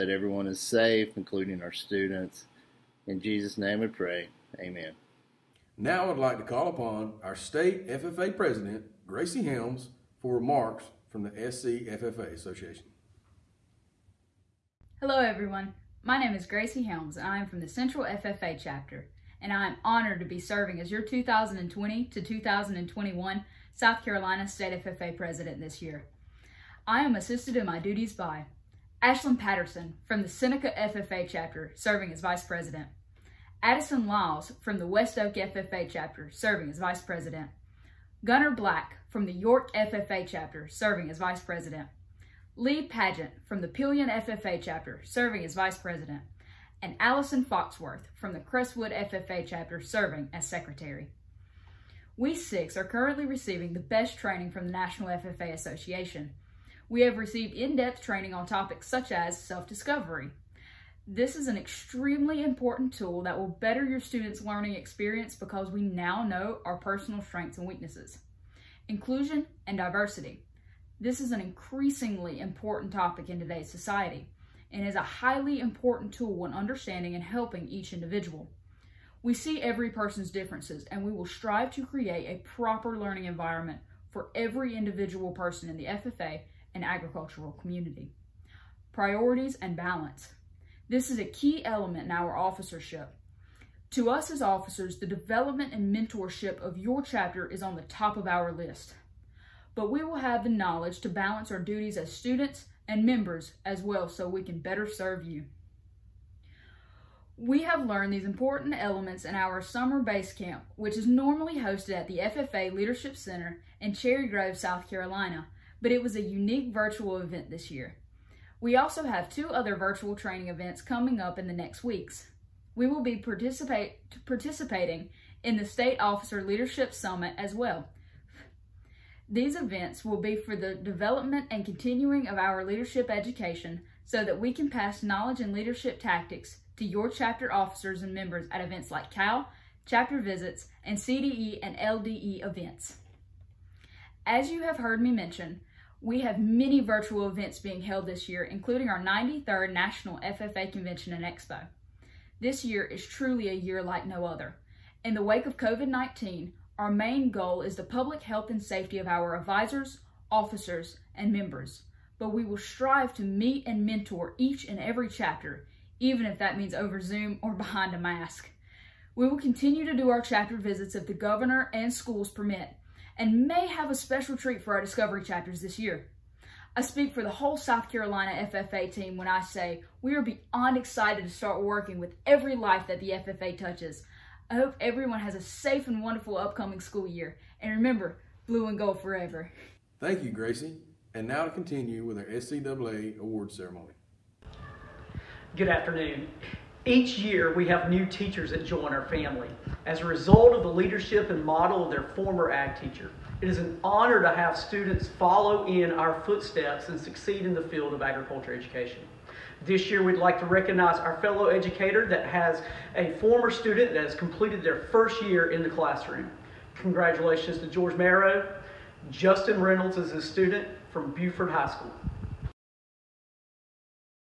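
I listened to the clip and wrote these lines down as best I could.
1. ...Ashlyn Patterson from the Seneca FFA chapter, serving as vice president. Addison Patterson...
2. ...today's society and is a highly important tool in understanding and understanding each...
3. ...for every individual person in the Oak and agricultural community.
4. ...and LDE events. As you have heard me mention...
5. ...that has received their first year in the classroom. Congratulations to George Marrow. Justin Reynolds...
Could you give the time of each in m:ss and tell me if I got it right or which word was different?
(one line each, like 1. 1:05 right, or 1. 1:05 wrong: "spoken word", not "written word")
1. 0:29 wrong: "Lyles", not "Patterson"
2. 1:13 wrong: "helping", not "understanding"
3. 1:24 wrong: "FFA", not "Oak"
4. 2:21 right
5. 3:33 wrong: "completed", not "received".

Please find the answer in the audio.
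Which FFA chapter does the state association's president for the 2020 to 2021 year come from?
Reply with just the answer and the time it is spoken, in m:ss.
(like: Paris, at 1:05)
Central, at 0:17.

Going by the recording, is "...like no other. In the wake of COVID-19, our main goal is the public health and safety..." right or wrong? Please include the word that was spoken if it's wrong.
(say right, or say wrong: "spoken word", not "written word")
right.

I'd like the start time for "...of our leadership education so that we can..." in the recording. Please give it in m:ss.
2:12.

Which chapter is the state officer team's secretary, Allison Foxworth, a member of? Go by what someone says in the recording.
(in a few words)
Crestwood.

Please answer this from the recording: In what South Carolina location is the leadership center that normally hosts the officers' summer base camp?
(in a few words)
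Cherry Grove.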